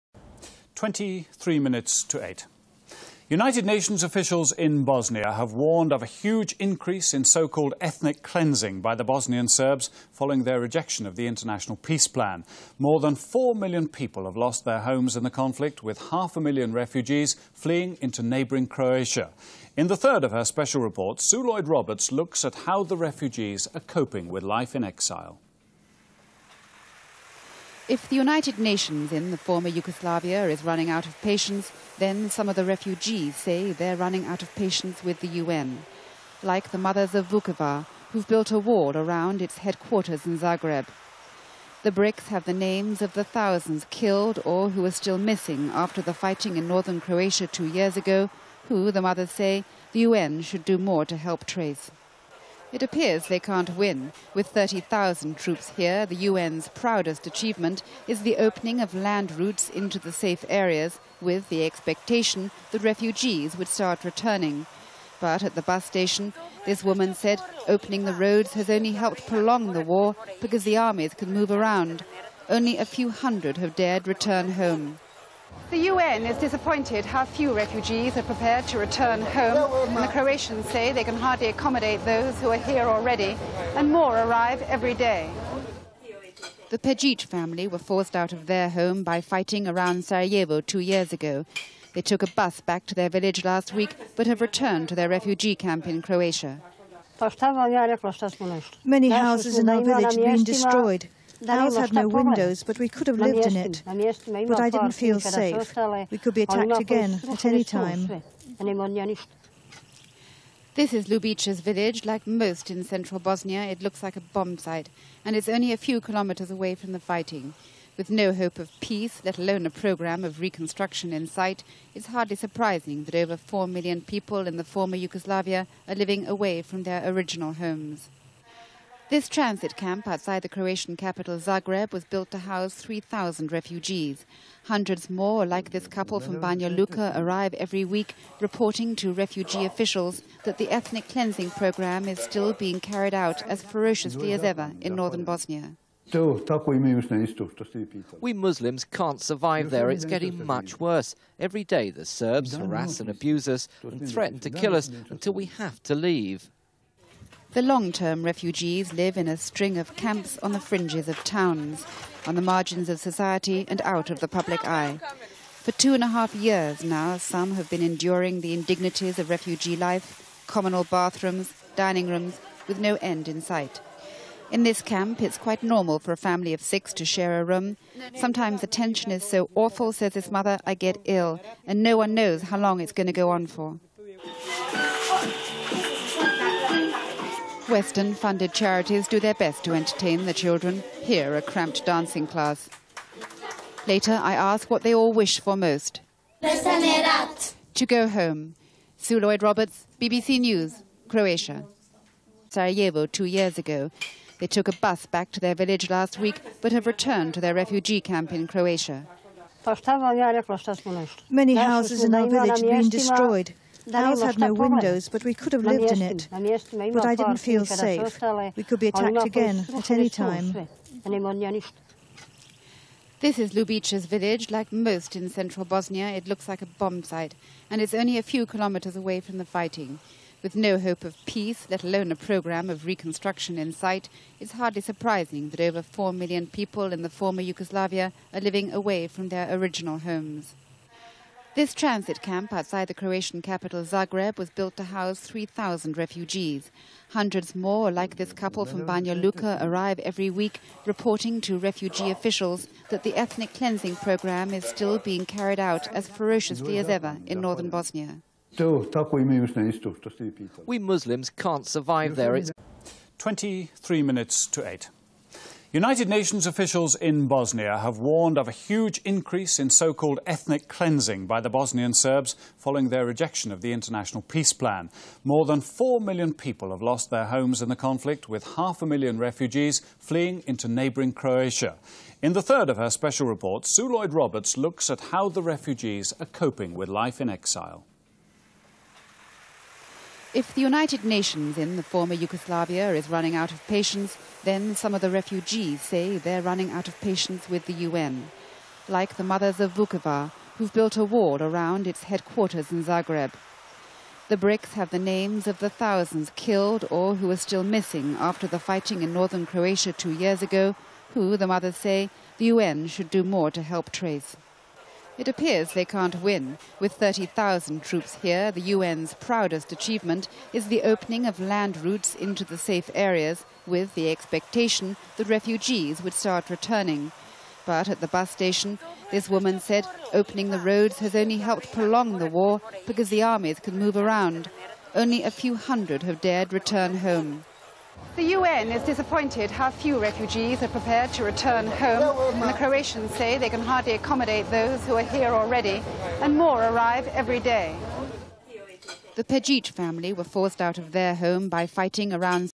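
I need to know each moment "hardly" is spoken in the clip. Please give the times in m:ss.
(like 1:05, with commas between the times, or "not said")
1:21, 2:02, 3:54, 5:43.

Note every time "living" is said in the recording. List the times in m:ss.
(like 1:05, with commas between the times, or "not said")
2:05, 3:58.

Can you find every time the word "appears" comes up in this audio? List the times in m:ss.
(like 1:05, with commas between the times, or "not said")
0:52, 5:15.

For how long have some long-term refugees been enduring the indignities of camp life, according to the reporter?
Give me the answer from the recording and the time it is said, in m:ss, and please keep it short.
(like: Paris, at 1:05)
two and a half years, at 2:45.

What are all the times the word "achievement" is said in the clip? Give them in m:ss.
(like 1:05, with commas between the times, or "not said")
0:57, 5:19.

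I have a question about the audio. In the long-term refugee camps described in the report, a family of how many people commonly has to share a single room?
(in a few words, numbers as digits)
6.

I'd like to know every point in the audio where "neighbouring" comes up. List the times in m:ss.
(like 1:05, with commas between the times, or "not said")
0:18, 4:40.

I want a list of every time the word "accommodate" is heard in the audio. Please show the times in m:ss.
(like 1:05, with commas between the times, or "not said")
1:21, 5:43.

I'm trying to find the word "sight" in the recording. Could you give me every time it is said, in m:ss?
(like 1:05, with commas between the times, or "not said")
2:01, 2:53, 3:53.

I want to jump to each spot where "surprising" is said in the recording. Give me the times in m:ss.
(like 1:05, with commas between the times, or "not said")
2:02, 3:54.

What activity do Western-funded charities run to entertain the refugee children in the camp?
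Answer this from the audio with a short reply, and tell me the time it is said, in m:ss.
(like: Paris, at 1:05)
dancing class, at 3:11.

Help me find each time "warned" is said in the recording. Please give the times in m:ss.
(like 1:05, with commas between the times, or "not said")
0:05, 4:27.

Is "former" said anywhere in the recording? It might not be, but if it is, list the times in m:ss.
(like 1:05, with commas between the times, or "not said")
0:29, 2:04, 3:57, 4:51.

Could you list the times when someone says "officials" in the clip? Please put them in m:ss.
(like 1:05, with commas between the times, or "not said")
0:04, 2:19, 4:12, 4:26.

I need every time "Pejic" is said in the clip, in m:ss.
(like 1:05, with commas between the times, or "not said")
1:26, 5:49.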